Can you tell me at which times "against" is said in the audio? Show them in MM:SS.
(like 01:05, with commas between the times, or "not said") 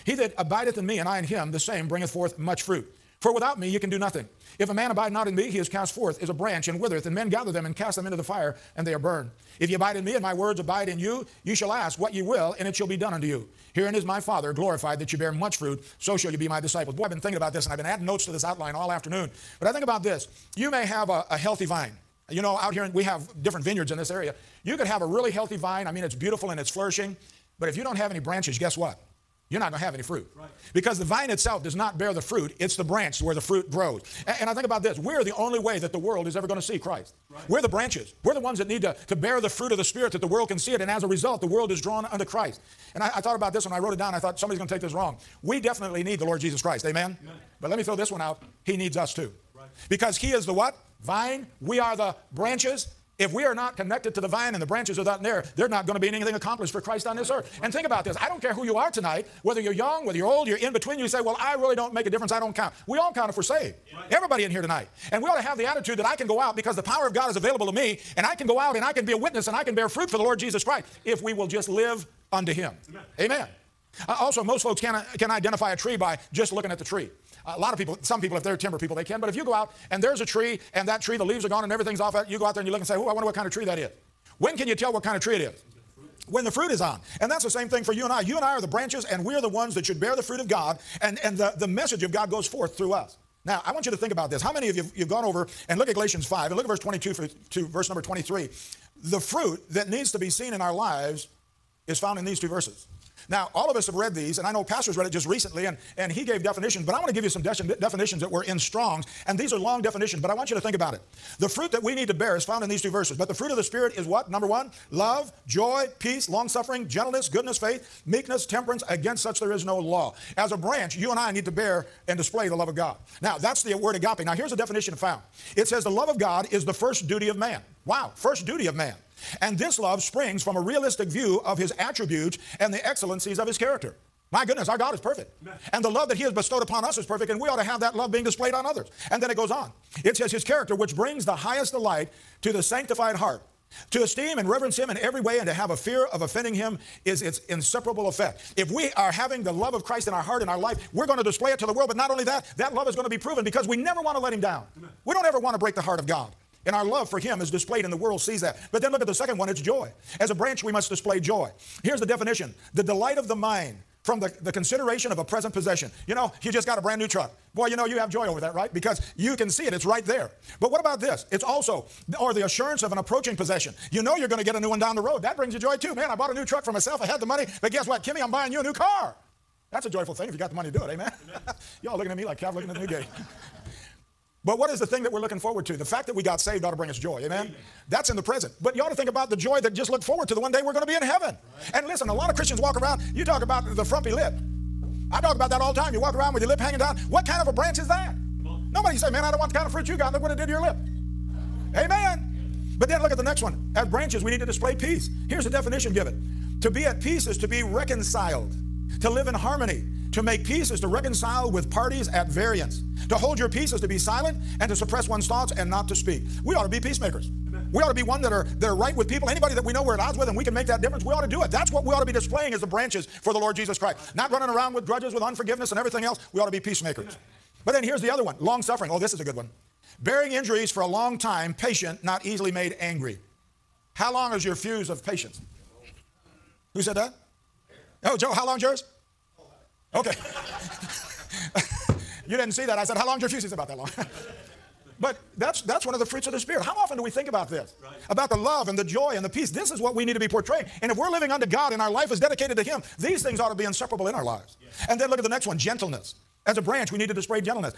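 01:58.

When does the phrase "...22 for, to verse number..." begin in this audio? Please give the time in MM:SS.
01:36.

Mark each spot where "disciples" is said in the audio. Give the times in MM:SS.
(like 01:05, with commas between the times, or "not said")
00:16.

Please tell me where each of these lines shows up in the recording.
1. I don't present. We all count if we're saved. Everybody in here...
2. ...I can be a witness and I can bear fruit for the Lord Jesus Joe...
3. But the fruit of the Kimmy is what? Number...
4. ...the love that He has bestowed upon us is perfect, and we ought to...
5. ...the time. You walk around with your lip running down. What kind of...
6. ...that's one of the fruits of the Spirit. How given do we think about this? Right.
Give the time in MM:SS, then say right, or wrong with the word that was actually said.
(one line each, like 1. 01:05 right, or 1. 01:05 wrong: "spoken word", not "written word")
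1. 01:02 wrong: "count", not "present"
2. 01:08 wrong: "Christ", not "Joe"
3. 01:53 wrong: "Spirit", not "Kimmy"
4. 02:15 right
5. 03:15 wrong: "hanging", not "running"
6. 04:05 wrong: "often", not "given".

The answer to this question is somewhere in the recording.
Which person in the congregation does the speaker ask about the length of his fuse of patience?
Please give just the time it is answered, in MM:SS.
03:58.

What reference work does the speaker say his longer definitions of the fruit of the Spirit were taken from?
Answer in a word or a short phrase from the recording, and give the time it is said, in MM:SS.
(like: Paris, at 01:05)
Strong's, at 01:48.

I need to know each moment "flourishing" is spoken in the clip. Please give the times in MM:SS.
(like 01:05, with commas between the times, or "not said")
00:26.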